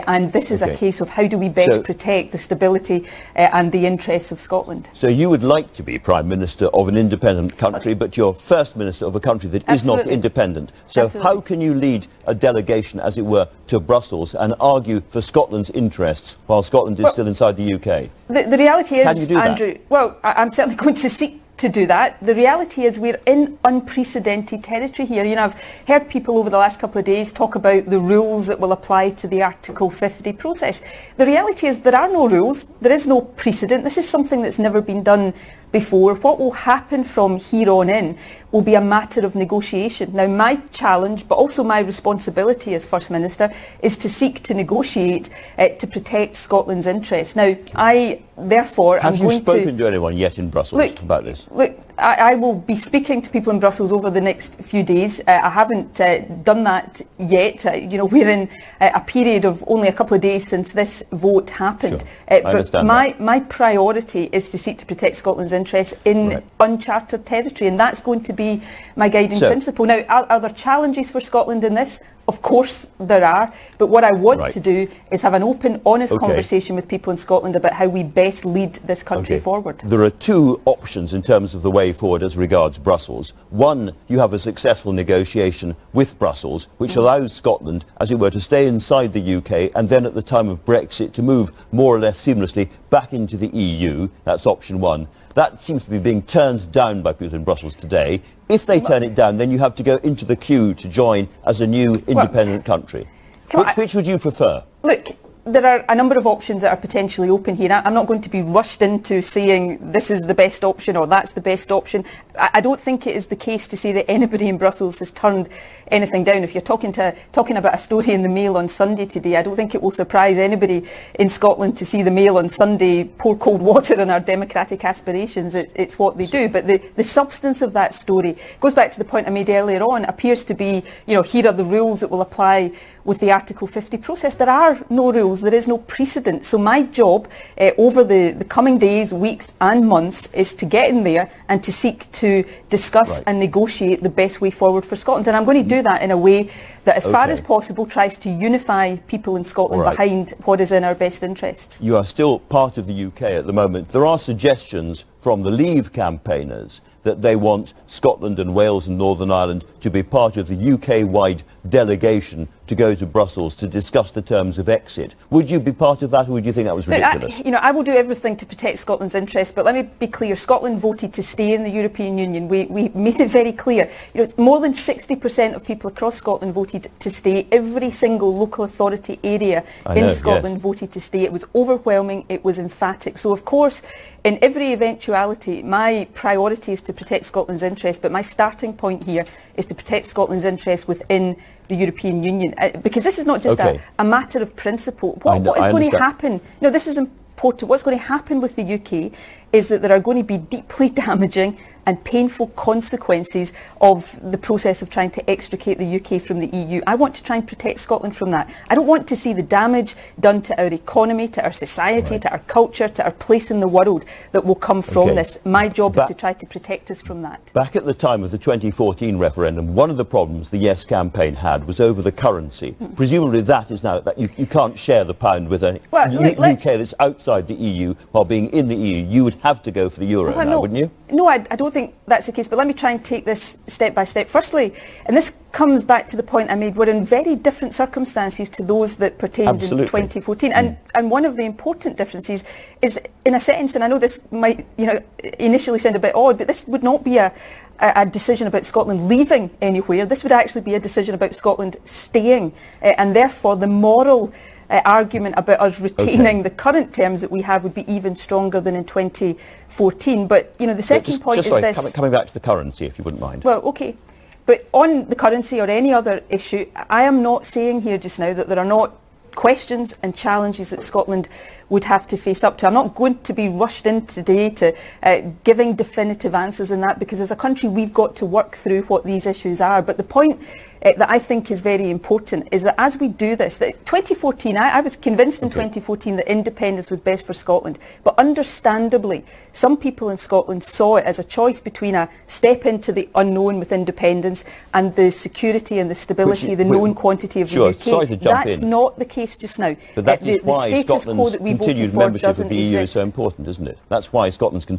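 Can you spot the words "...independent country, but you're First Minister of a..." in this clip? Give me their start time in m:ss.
0:06.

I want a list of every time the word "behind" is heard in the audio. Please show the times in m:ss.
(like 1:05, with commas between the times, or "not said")
2:29.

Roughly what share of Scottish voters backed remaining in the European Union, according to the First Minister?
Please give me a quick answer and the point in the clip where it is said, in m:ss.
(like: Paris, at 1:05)
more than 60%, at 2:54.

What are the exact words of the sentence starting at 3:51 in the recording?
No, I, I don't think think that's the case, but let me try and take this step by step.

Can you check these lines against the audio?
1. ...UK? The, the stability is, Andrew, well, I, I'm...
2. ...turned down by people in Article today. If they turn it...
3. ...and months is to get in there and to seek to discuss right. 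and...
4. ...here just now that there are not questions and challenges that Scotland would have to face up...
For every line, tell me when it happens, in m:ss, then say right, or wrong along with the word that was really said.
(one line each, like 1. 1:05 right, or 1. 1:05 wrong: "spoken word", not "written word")
1. 0:17 wrong: "reality", not "stability"
2. 1:36 wrong: "Brussels", not "Article"
3. 2:19 right
4. 4:27 right.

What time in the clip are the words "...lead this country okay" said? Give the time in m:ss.
1:18.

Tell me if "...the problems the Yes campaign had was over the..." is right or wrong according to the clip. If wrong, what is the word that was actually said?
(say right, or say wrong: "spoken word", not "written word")
right.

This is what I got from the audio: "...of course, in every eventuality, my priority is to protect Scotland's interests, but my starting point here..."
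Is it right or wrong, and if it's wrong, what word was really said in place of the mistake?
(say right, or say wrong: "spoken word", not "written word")
right.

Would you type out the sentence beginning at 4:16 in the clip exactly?
the current terms that we have would be even stronger than in 2014.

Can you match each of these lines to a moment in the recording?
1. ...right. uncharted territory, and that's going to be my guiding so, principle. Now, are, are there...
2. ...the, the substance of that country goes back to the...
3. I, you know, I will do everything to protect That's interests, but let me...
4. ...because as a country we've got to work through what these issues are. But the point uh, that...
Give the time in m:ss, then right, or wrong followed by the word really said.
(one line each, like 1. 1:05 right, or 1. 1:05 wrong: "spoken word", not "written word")
1. 1:06 right
2. 2:06 wrong: "story", not "country"
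3. 2:47 wrong: "Scotland", not "That"
4. 4:36 right.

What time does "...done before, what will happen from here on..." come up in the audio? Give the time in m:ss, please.
0:35.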